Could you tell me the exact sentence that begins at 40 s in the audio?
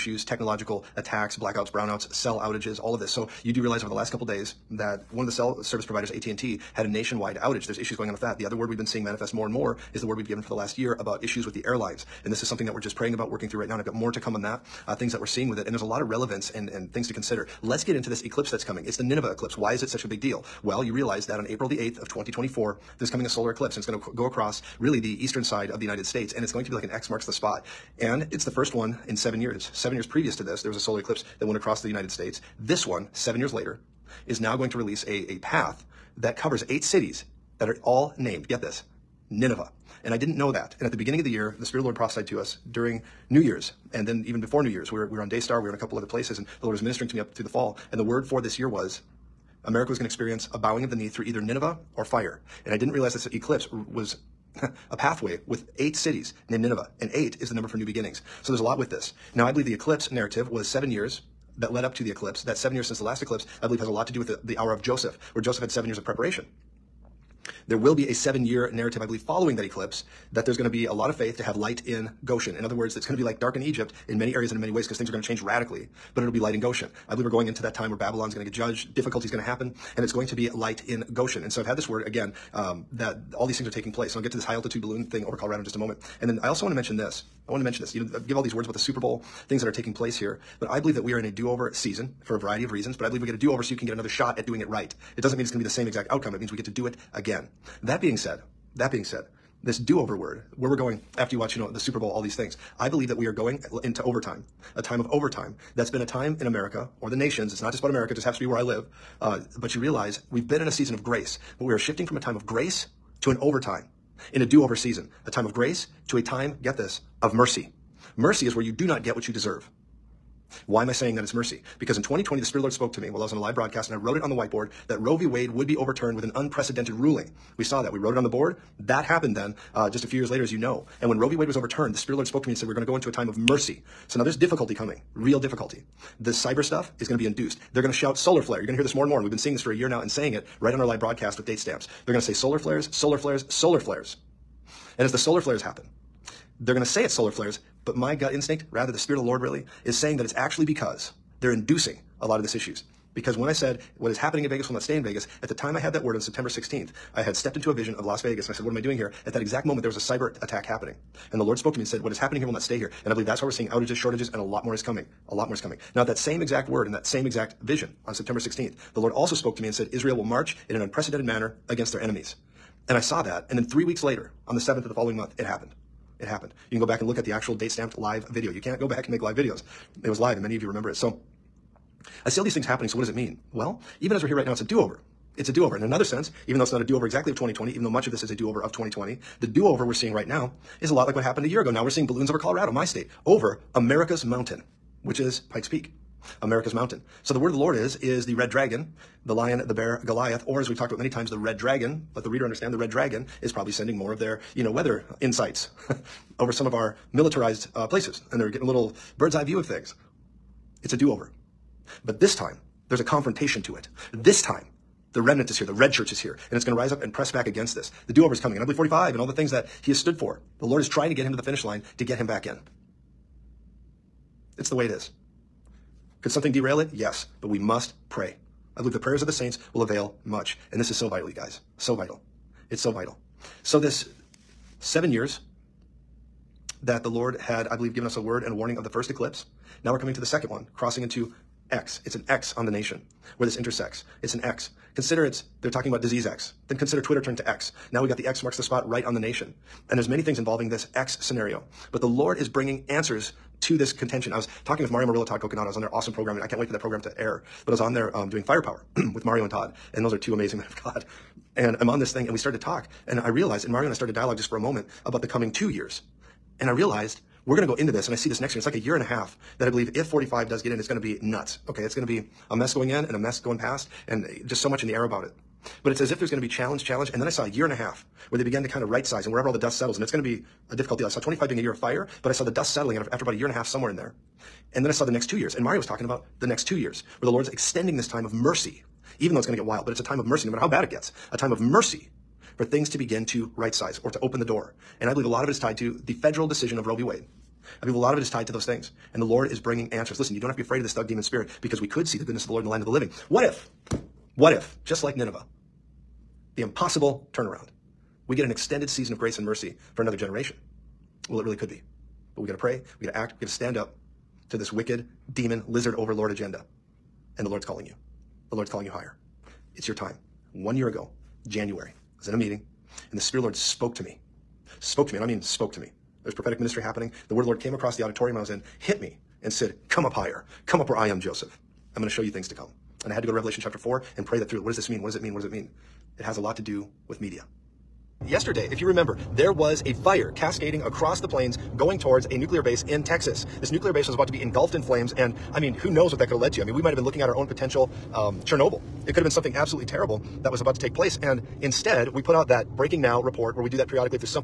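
And at the beginning of the year, the Spirit of the Lord prophesied to us during New Year's.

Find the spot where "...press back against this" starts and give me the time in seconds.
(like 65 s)
217 s.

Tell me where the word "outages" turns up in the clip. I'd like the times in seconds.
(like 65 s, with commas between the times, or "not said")
2 s, 7 s, 163 s.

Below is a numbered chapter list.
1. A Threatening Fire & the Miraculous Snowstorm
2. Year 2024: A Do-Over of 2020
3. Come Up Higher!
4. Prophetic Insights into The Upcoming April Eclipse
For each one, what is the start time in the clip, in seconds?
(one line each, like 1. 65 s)
1. 330 s
2. 177 s
3. 322 s
4. 11 s.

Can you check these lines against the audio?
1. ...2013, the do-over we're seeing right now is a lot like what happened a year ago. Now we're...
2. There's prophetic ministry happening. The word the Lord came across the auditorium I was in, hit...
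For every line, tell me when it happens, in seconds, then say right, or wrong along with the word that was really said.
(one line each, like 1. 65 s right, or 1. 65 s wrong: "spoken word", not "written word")
1. 188 s wrong: "2020", not "2013"
2. 326 s right.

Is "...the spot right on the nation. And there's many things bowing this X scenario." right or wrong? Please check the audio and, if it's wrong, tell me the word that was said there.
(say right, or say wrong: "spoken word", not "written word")
wrong: "involving", not "bowing".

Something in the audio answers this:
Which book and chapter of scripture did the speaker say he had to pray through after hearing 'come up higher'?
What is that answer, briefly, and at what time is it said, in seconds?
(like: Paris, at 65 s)
Revelation chapter 4, at 333 s.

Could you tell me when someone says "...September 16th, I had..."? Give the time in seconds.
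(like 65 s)
156 s.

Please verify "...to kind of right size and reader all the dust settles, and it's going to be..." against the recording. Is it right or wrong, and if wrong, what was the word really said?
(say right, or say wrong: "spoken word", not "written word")
wrong: "wherever", not "reader".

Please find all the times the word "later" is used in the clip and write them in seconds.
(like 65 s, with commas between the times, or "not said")
33 s, 130 s, 174 s.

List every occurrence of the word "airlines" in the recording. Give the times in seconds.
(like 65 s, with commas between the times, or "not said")
11 s.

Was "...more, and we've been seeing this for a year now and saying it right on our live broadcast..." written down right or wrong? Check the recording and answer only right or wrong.
right.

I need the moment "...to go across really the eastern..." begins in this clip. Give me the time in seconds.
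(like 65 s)
24 s.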